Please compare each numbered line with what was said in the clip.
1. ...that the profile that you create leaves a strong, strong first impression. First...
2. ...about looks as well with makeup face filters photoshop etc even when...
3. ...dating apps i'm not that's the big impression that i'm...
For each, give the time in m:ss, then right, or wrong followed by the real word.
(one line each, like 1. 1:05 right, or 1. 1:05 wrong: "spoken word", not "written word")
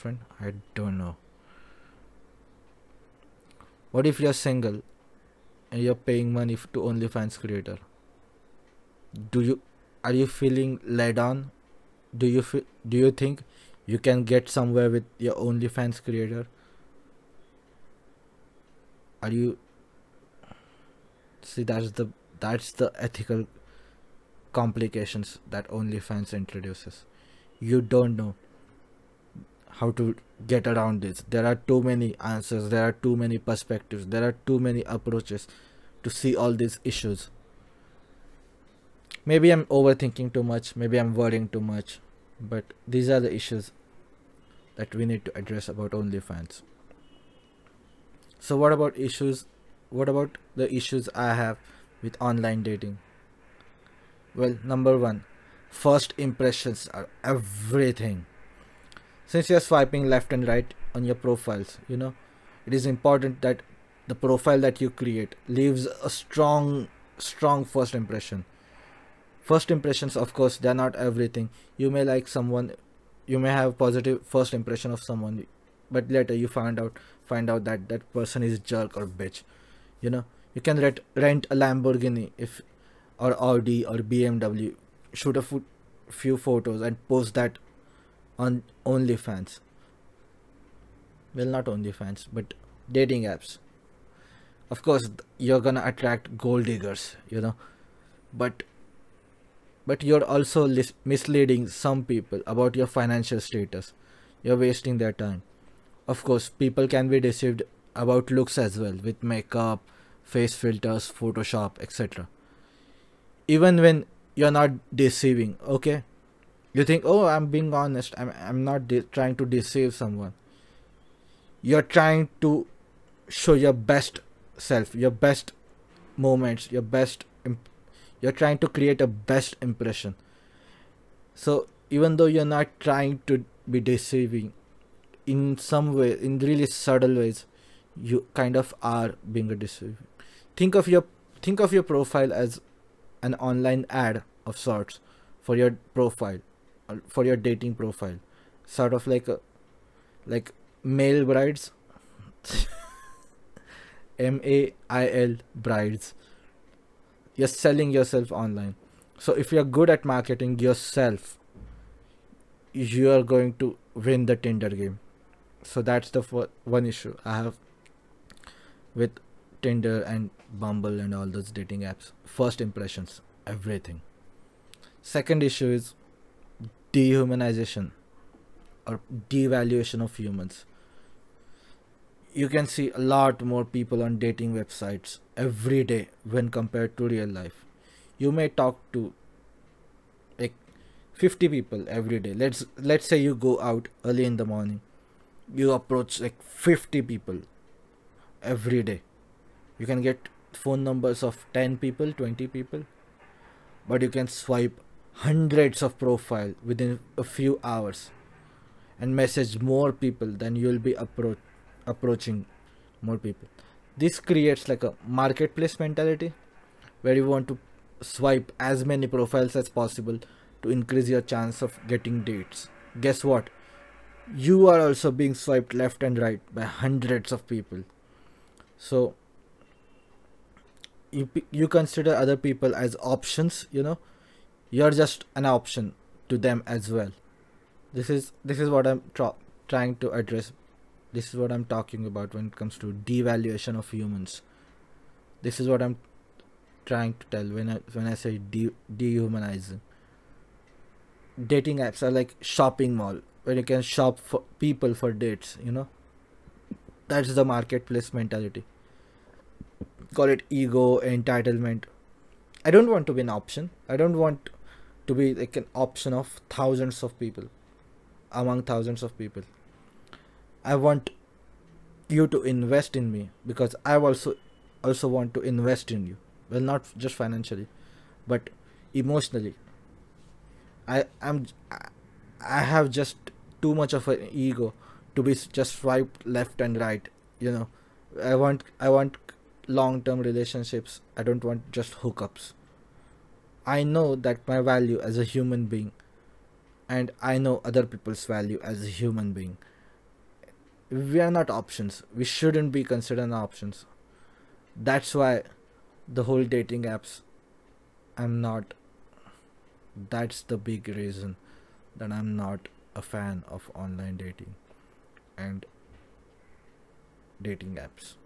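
1. 1:03 right
2. 1:47 right
3. 5:06 wrong: "reason", not "impression".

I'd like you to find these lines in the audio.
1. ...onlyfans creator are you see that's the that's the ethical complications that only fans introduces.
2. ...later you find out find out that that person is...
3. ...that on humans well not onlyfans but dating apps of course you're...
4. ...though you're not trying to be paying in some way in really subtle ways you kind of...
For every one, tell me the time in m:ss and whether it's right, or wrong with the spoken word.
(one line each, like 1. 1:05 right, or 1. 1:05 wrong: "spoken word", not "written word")
1. 0:15 right
2. 1:16 right
3. 1:27 wrong: "onlyfans", not "humans"
4. 2:12 wrong: "deceiving", not "paying".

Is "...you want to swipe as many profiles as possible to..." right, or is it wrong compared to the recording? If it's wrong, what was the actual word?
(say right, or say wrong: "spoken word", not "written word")
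right.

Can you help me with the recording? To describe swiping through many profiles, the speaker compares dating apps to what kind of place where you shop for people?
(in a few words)
Shopping mall.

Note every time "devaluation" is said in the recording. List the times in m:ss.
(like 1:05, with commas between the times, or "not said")
2:59, 4:03.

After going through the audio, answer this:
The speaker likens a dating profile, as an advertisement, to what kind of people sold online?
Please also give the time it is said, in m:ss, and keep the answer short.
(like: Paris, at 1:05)
Mail brides, at 2:30.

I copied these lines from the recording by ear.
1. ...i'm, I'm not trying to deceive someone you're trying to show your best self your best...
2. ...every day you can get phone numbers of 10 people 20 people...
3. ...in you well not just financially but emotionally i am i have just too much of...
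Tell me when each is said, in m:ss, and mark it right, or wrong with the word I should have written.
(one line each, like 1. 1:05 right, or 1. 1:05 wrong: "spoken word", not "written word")
1. 1:58 right
2. 3:18 right
3. 4:35 right.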